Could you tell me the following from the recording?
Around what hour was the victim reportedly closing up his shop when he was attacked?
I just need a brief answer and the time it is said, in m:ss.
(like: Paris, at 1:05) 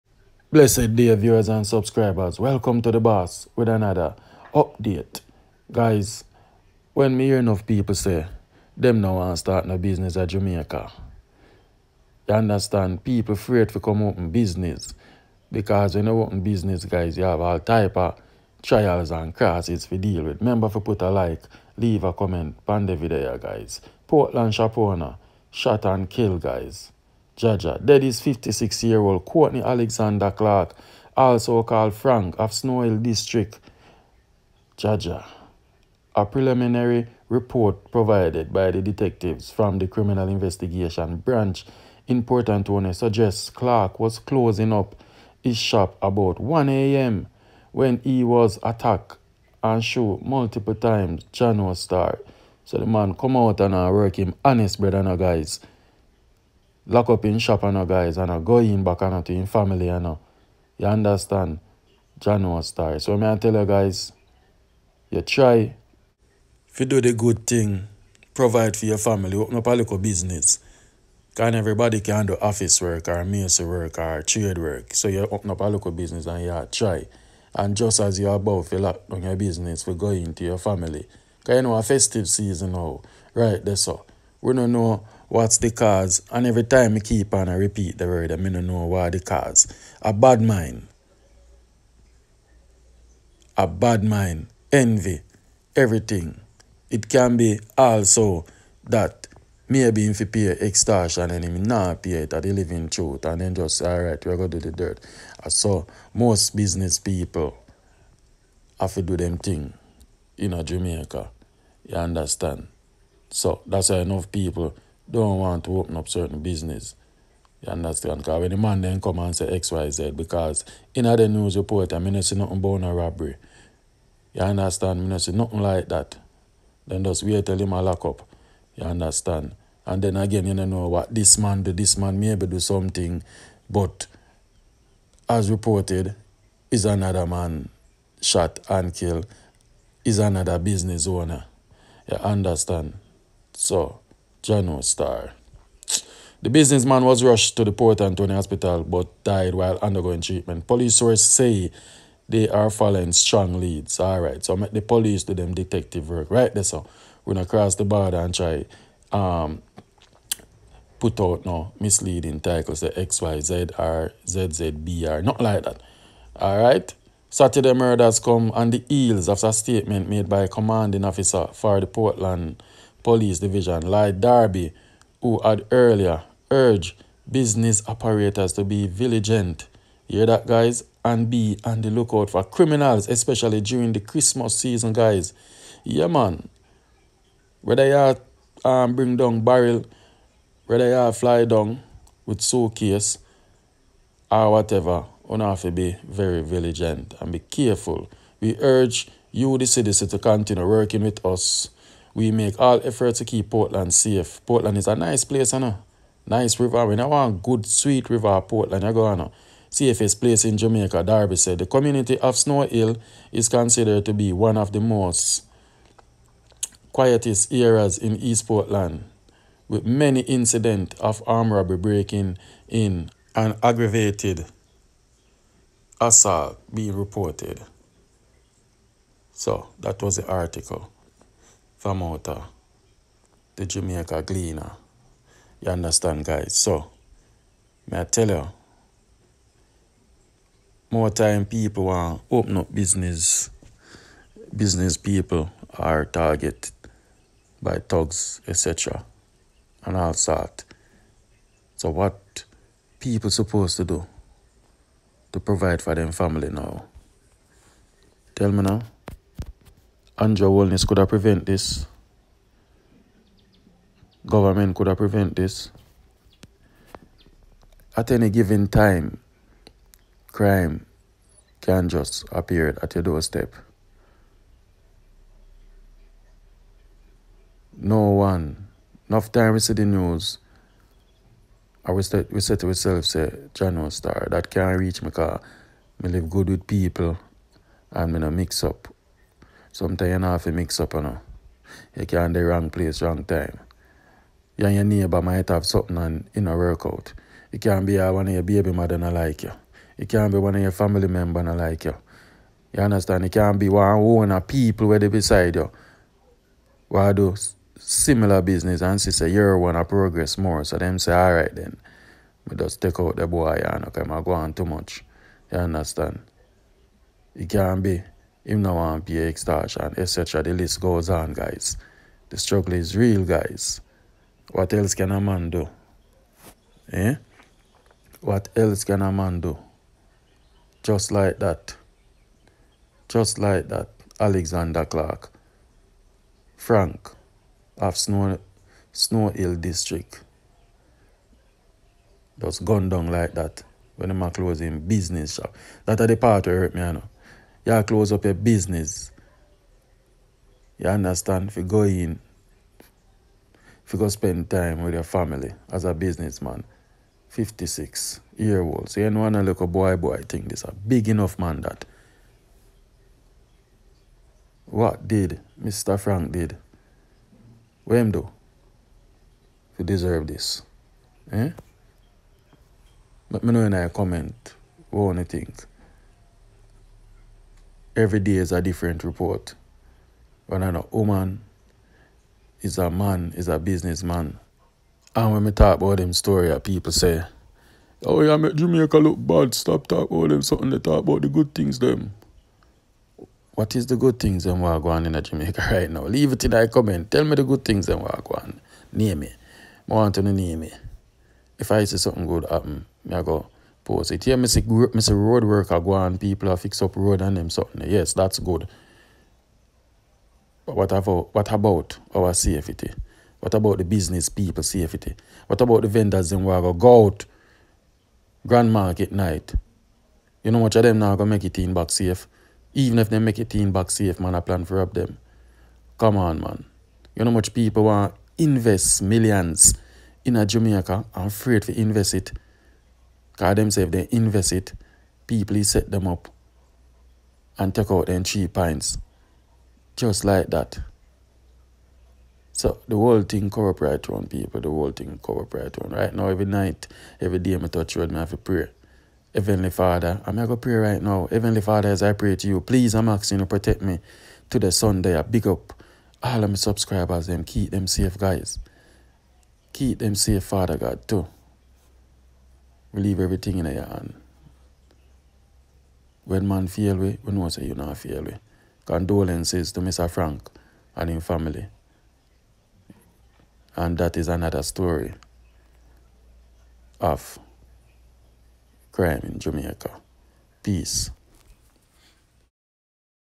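1 a.m., at 0:45.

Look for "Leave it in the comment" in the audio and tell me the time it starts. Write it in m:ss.
6:36.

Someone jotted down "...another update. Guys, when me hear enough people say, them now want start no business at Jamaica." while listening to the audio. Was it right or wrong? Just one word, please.
right.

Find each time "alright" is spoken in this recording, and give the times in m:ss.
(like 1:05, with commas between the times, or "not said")
1:43, 5:11.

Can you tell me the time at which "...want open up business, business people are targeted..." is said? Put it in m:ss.
4:01.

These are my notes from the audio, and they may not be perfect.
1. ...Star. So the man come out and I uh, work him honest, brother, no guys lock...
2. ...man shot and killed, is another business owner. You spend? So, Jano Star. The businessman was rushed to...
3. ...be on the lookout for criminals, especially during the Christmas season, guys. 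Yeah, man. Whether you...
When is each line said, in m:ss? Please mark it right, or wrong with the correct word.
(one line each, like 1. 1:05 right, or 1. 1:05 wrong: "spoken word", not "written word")
1. 0:51 right
2. 2:17 wrong: "understand", not "spend"
3. 3:01 right.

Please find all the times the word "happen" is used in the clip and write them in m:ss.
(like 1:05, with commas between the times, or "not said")
6:42.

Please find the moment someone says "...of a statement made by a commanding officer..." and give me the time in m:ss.
2:49.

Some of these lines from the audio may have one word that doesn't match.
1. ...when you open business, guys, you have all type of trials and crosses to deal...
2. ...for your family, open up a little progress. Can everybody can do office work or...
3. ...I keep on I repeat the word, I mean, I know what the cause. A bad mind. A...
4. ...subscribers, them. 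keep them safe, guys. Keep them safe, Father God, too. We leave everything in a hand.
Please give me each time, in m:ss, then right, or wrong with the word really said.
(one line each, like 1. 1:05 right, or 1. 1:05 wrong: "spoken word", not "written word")
1. 0:15 right
2. 1:08 wrong: "business", not "progress"
3. 1:26 right
4. 7:36 right.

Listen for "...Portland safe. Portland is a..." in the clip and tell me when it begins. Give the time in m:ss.
3:23.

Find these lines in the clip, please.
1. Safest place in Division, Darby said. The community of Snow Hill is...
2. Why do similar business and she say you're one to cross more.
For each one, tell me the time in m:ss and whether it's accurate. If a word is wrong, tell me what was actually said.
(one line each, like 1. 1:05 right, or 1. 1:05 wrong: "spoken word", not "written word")
1. 3:29 wrong: "Jamaica", not "Division"
2. 5:06 wrong: "progress", not "cross".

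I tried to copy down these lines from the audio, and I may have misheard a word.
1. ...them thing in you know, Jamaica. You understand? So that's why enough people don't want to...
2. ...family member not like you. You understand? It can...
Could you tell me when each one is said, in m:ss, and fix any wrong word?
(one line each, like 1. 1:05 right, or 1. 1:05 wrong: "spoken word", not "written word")
1. 1:49 right
2. 5:00 right.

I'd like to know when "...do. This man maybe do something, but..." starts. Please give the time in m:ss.
2:11.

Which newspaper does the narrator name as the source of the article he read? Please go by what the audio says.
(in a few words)
The Jamaica Gleaner.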